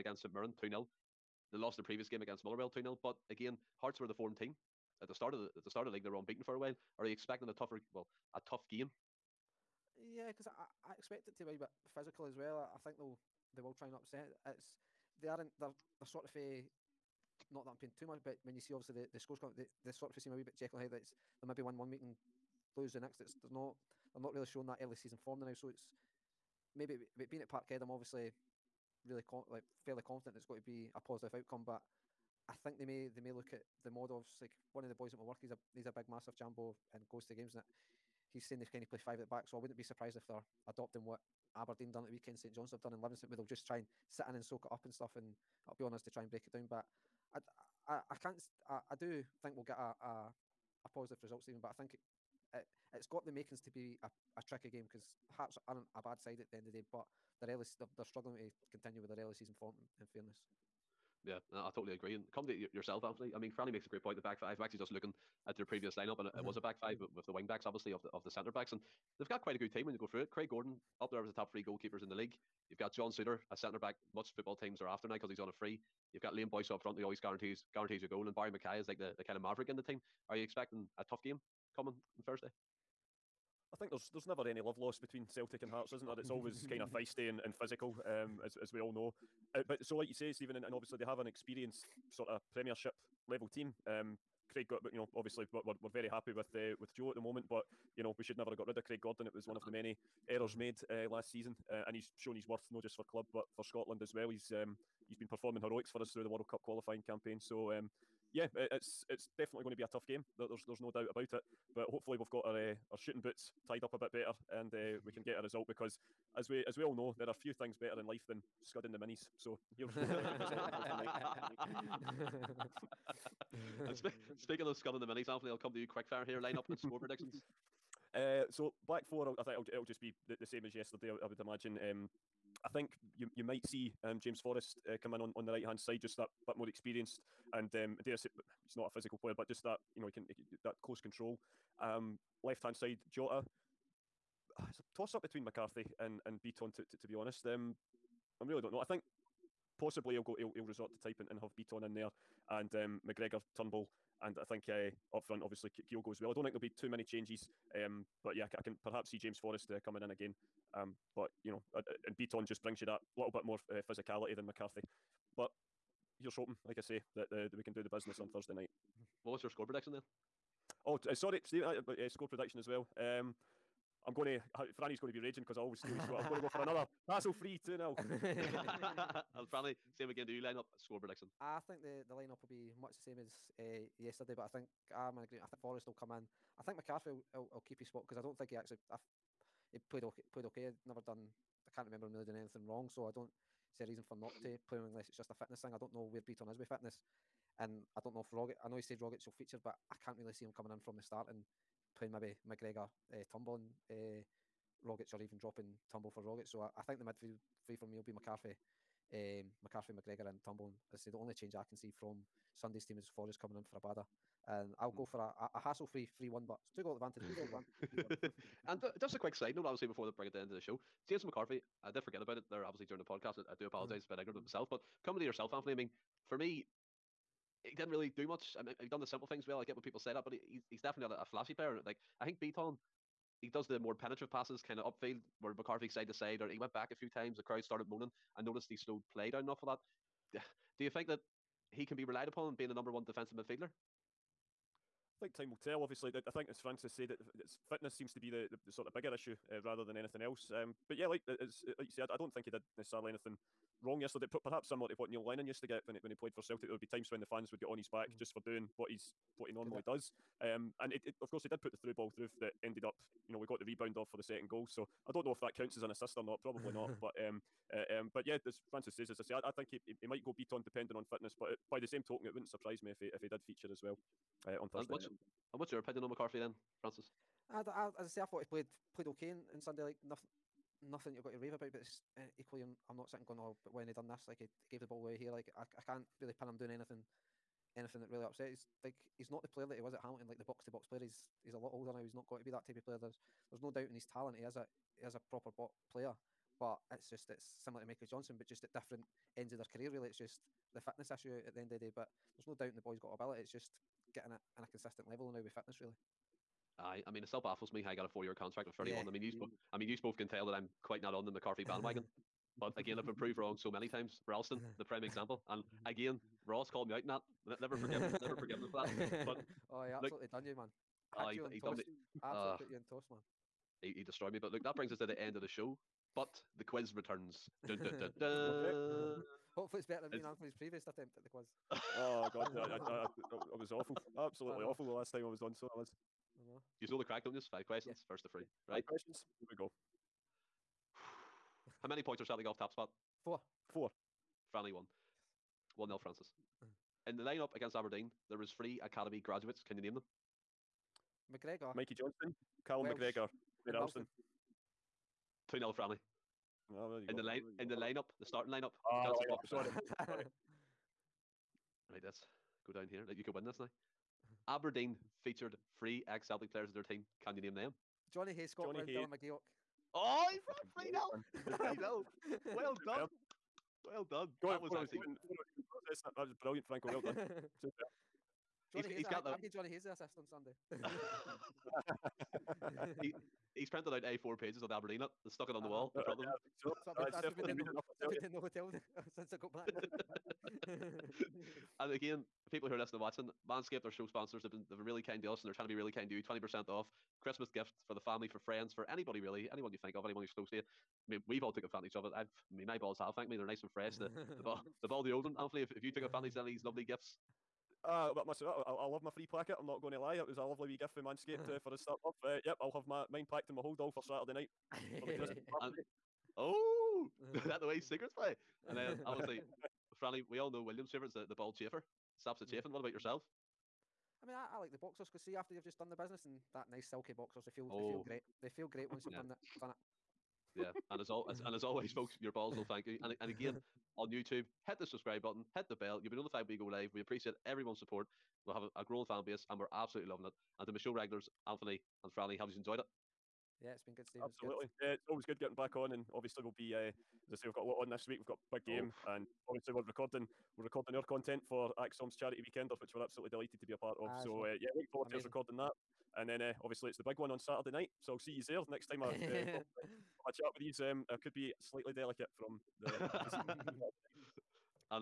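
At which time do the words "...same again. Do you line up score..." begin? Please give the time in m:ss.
2:59.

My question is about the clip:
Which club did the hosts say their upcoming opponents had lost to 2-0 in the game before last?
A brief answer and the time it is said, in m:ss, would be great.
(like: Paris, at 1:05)
Motherwell, at 0:02.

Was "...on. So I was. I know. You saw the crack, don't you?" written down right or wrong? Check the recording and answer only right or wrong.
right.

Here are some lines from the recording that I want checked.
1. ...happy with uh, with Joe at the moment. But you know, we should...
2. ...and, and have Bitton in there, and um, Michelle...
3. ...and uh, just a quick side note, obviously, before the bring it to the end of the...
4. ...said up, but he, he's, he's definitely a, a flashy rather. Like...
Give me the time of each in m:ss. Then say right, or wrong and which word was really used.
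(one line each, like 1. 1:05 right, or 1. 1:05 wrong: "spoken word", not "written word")
1. 1:36 right
2. 2:31 wrong: "McGregor", not "Michelle"
3. 3:38 right
4. 3:49 wrong: "player", not "rather".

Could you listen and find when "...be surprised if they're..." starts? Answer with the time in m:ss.
0:39.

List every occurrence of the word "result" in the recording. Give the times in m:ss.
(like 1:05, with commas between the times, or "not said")
0:51, 1:55.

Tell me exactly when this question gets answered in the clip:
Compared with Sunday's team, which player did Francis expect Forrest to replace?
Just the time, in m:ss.
3:33.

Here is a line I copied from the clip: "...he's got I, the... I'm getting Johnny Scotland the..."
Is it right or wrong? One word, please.
wrong.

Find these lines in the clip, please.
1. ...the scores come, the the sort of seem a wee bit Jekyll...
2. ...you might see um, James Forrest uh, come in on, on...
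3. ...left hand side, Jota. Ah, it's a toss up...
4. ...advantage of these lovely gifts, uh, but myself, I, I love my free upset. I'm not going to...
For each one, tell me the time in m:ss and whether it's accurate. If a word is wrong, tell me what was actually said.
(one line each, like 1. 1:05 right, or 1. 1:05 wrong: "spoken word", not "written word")
1. 0:19 right
2. 2:13 right
3. 2:22 right
4. 6:46 wrong: "placket", not "upset".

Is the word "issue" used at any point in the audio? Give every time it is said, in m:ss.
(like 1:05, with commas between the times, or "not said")
4:09, 5:01.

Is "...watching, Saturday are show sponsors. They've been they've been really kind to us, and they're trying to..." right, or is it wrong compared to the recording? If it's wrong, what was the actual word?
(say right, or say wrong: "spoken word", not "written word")
wrong: "Manscaped", not "Saturday".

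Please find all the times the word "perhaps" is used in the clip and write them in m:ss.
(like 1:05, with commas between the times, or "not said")
2:38, 4:14.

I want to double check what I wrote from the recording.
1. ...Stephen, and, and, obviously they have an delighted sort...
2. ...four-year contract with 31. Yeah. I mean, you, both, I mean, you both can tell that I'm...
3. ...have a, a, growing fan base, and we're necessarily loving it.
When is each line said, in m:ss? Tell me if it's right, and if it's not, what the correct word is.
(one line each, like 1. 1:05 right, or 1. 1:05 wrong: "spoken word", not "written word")
1. 1:30 wrong: "experienced", not "delighted"
2. 5:08 right
3. 7:18 wrong: "absolutely", not "necessarily".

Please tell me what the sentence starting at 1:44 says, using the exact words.
He's um, he's been performing heroics for us through the World Cup qualifying campaign.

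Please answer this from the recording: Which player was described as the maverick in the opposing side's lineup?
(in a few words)
Barrie McKay.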